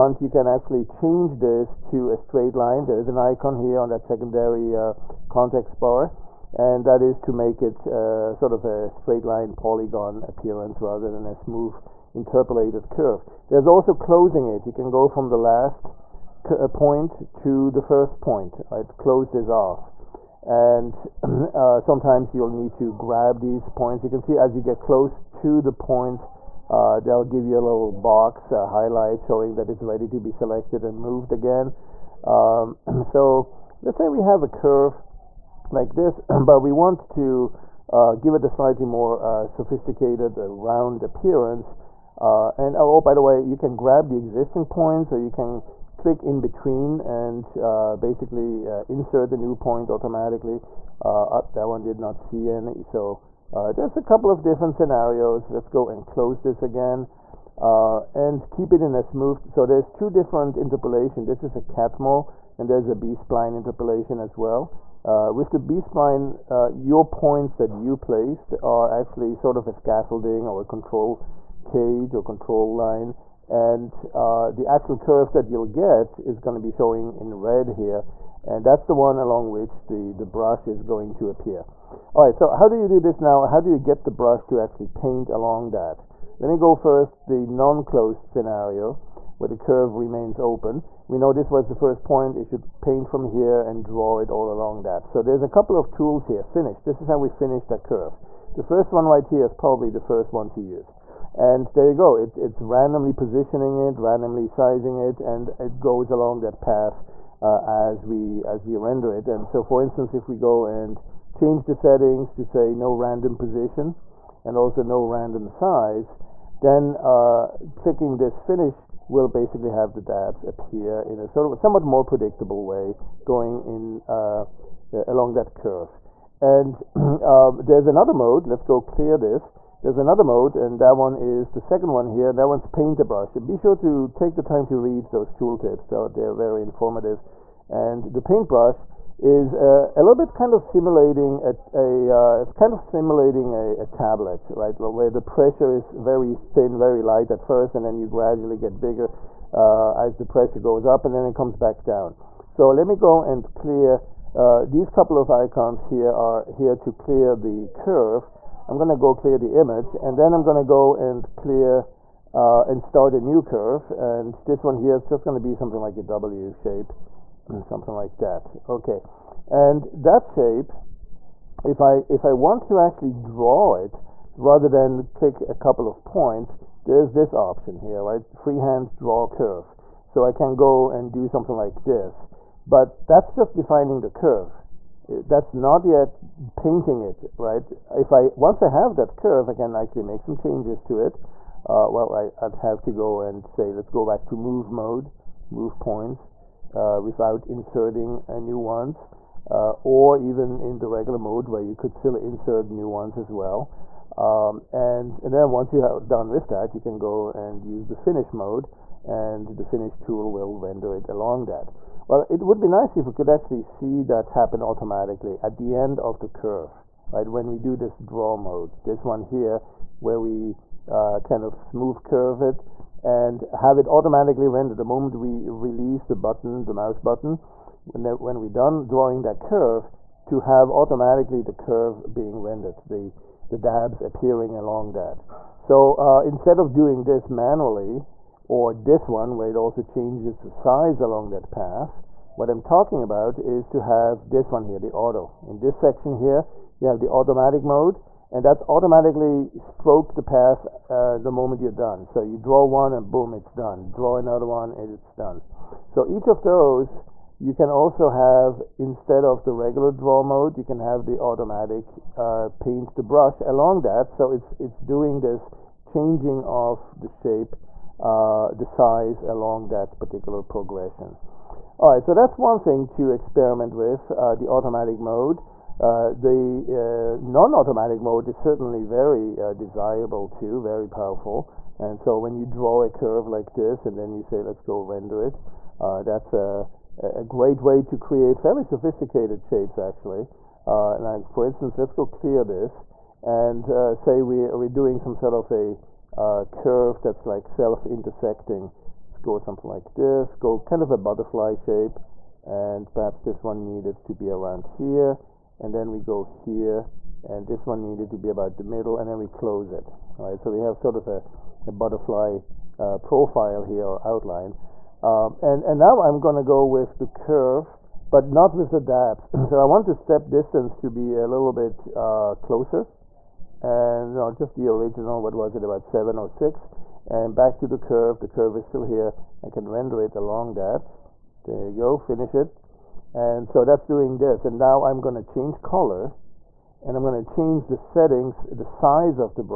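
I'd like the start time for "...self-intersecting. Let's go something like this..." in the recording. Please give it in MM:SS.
04:57.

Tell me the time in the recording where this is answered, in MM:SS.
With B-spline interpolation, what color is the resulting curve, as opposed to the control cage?
01:17.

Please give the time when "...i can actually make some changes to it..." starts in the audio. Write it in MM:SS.
03:09.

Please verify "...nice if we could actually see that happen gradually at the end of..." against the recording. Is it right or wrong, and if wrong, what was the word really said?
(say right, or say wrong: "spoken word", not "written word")
wrong: "automatically", not "gradually".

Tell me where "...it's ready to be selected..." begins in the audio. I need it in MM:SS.
00:29.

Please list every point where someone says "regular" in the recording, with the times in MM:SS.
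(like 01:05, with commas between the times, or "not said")
03:20, 04:19.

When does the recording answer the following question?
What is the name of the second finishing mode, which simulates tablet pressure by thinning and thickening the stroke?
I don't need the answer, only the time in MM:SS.
02:12.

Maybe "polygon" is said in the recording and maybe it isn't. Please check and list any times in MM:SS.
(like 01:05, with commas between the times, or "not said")
00:09.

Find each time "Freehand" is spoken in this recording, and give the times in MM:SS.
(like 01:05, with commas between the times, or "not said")
02:58.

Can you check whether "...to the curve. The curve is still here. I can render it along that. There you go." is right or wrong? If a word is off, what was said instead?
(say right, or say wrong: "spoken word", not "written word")
right.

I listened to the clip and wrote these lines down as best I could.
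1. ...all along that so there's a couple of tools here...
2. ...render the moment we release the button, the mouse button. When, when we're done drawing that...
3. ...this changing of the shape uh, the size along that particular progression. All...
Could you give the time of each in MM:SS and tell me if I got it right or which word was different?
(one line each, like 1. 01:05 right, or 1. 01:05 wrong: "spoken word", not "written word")
1. 01:34 right
2. 03:44 right
3. 04:25 right.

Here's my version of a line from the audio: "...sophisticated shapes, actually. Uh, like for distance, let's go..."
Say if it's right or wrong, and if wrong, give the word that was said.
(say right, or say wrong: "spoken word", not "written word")
wrong: "instance", not "distance".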